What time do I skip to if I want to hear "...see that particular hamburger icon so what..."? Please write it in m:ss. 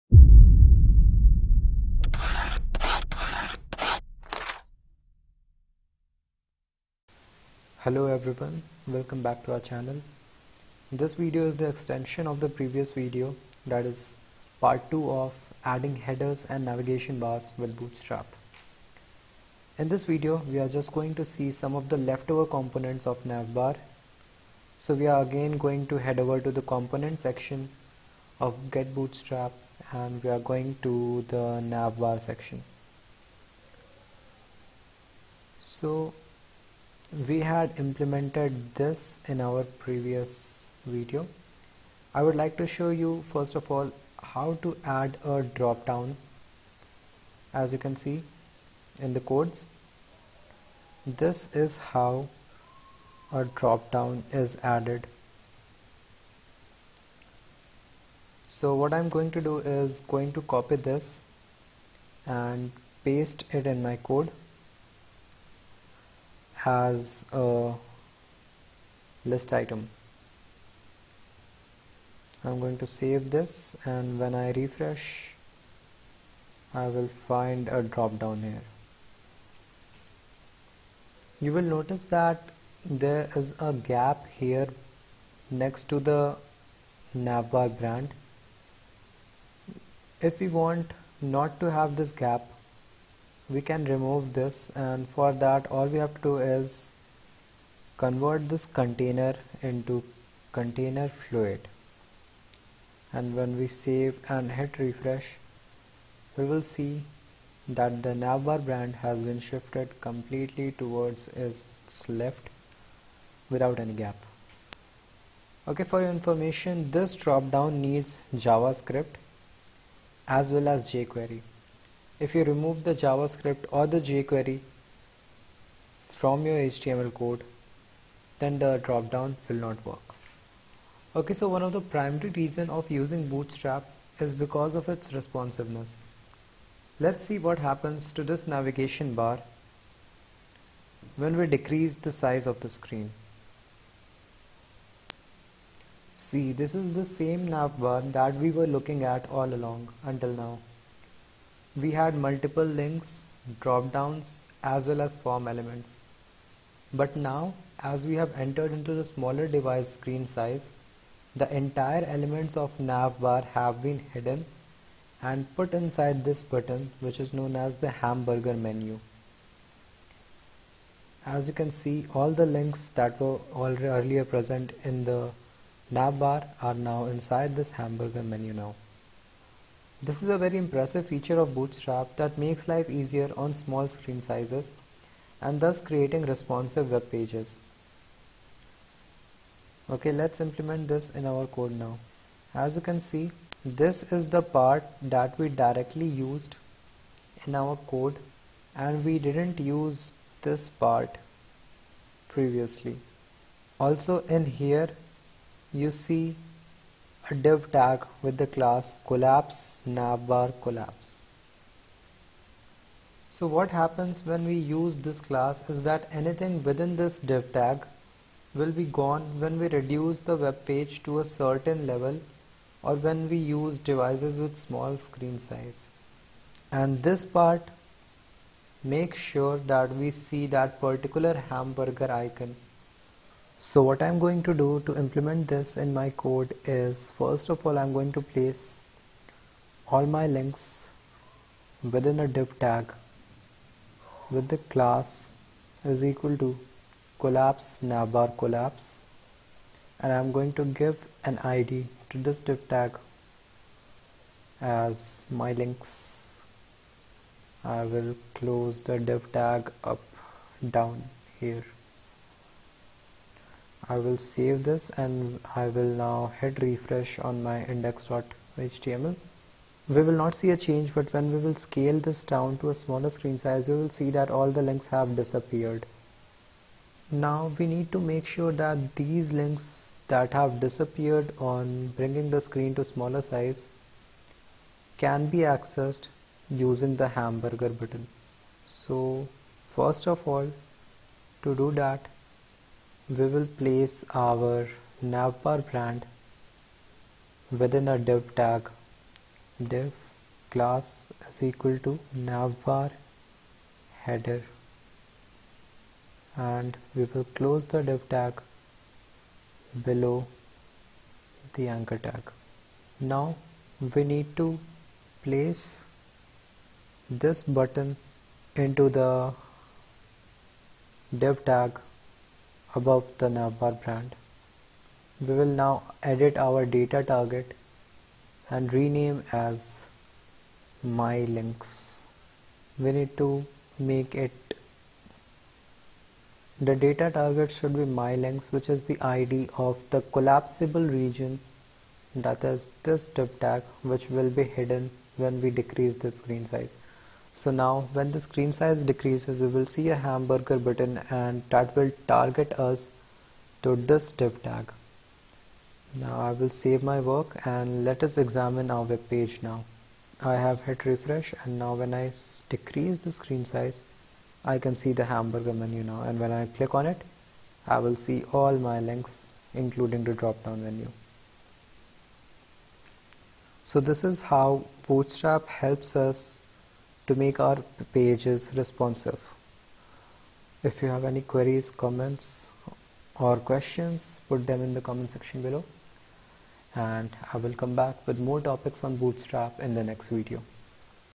3:50.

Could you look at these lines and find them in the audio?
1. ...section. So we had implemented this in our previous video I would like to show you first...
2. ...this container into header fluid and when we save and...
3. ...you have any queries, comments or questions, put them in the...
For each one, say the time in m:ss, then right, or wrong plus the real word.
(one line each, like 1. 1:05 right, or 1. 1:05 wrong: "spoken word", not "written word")
1. 0:32 right
2. 1:38 wrong: "container", not "header"
3. 6:20 right.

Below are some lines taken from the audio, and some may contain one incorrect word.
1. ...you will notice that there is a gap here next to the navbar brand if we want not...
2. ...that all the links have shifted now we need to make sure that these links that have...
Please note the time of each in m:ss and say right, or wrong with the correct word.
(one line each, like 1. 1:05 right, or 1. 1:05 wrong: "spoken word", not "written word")
1. 1:21 right
2. 4:34 wrong: "disappeared", not "shifted".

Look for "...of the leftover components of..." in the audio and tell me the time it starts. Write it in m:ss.
0:21.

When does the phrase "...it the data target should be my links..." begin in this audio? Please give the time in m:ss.
5:34.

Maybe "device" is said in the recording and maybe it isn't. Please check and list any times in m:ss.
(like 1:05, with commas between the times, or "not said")
2:39, 3:43.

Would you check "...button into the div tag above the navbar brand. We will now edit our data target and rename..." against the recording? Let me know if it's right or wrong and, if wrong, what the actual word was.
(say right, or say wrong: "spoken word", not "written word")
right.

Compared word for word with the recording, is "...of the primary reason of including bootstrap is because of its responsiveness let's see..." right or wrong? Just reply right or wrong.
wrong.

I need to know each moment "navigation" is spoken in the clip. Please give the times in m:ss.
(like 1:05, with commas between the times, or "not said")
0:16, 2:18.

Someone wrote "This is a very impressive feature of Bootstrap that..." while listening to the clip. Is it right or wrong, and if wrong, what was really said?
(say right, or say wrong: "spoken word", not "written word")
right.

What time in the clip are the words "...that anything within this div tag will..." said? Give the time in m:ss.
3:35.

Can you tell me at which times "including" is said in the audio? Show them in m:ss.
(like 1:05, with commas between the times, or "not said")
6:09.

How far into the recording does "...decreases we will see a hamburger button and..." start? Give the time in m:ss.
5:48.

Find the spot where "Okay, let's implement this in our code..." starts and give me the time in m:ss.
3:09.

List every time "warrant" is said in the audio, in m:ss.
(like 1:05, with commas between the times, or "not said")
not said.